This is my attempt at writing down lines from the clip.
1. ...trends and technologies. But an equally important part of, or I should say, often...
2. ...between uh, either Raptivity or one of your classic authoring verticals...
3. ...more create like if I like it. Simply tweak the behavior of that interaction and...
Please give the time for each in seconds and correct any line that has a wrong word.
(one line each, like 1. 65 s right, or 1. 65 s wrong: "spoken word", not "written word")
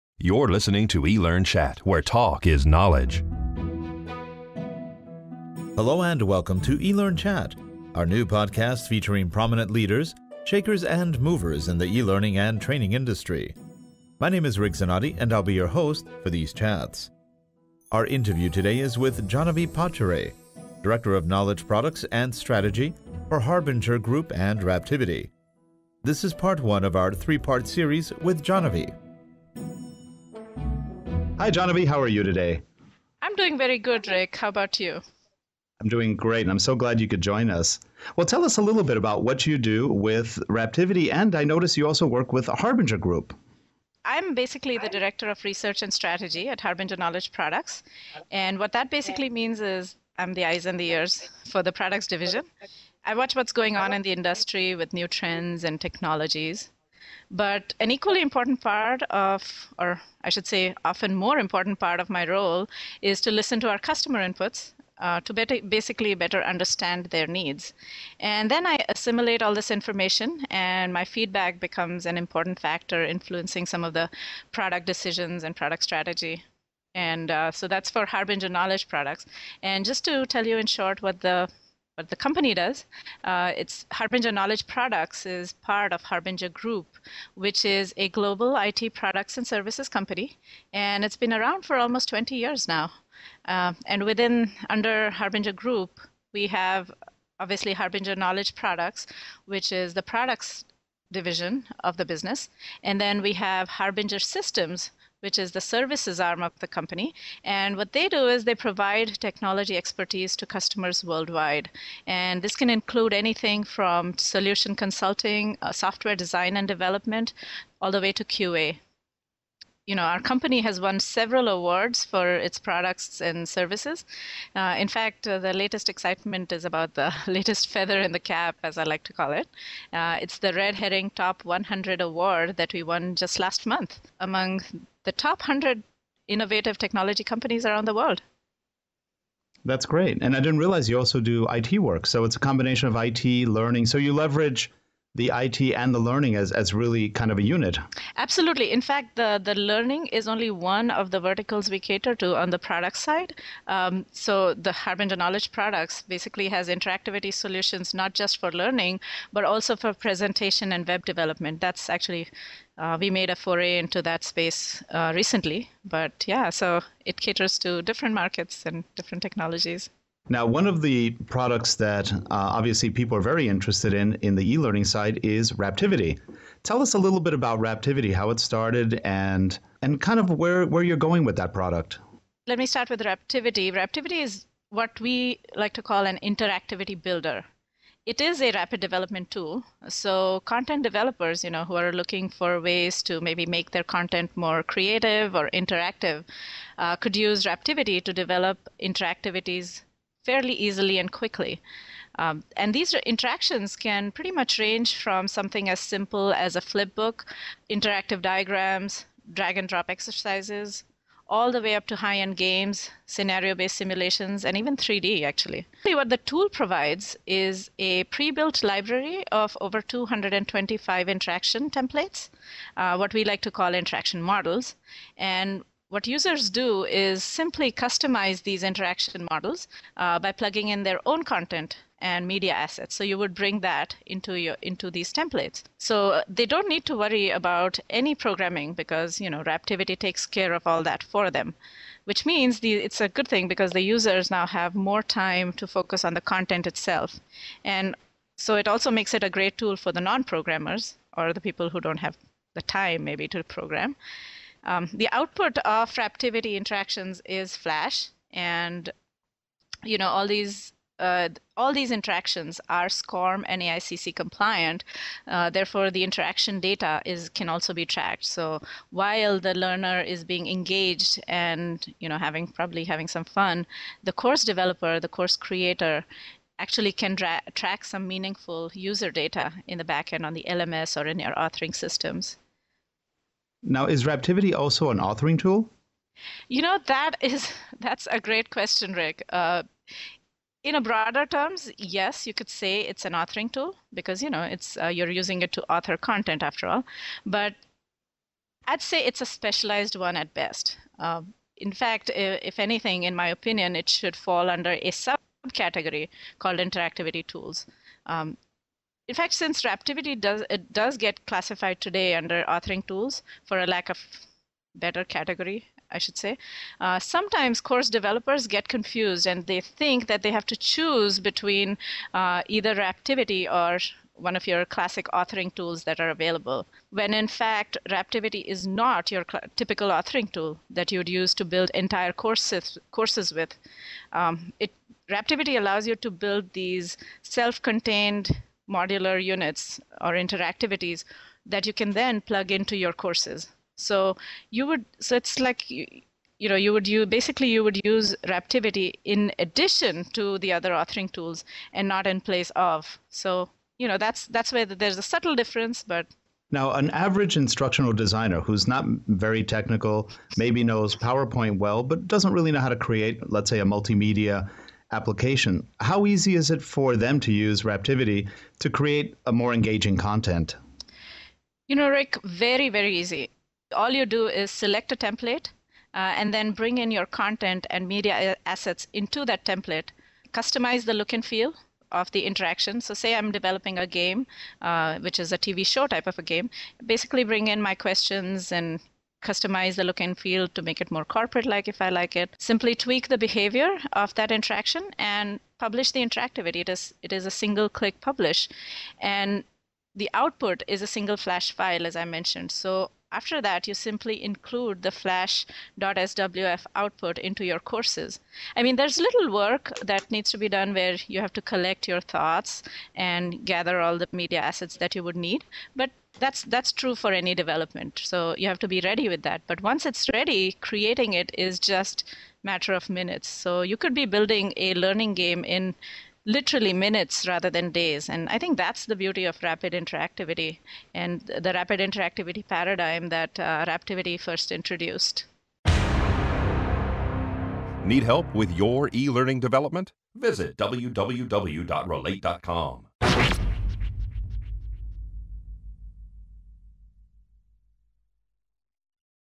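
1. 55 s right
2. 321 s wrong: "tools", not "verticals"
3. 390 s wrong: "corporate", not "create".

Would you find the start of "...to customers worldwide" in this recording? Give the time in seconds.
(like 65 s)
110 s.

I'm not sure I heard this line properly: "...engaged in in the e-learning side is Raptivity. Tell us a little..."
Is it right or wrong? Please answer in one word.
wrong.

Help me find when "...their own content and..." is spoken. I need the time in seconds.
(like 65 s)
230 s.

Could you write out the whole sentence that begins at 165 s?
But yeah, so it caters to different markets and different technologies.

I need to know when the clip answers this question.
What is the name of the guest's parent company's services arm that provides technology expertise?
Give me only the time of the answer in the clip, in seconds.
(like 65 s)
103 s.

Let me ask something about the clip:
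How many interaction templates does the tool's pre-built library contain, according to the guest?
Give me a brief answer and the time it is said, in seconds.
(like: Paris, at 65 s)
Over 225, at 219 s.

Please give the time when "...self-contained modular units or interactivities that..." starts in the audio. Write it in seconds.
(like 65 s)
337 s.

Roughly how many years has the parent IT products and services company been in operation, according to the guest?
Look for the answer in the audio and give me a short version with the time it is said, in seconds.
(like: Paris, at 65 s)
20 years, at 92 s.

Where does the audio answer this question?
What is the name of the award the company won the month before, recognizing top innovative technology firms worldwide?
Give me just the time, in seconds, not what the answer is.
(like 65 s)
130 s.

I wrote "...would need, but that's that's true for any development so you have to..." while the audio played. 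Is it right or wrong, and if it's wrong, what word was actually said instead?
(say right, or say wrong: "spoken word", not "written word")
right.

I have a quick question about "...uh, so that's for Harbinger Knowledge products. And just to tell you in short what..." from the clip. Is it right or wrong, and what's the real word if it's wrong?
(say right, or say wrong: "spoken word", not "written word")
right.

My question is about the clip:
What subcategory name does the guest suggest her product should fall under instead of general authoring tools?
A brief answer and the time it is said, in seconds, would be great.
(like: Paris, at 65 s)
Interactivity tools, at 306 s.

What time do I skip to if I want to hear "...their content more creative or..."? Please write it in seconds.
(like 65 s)
193 s.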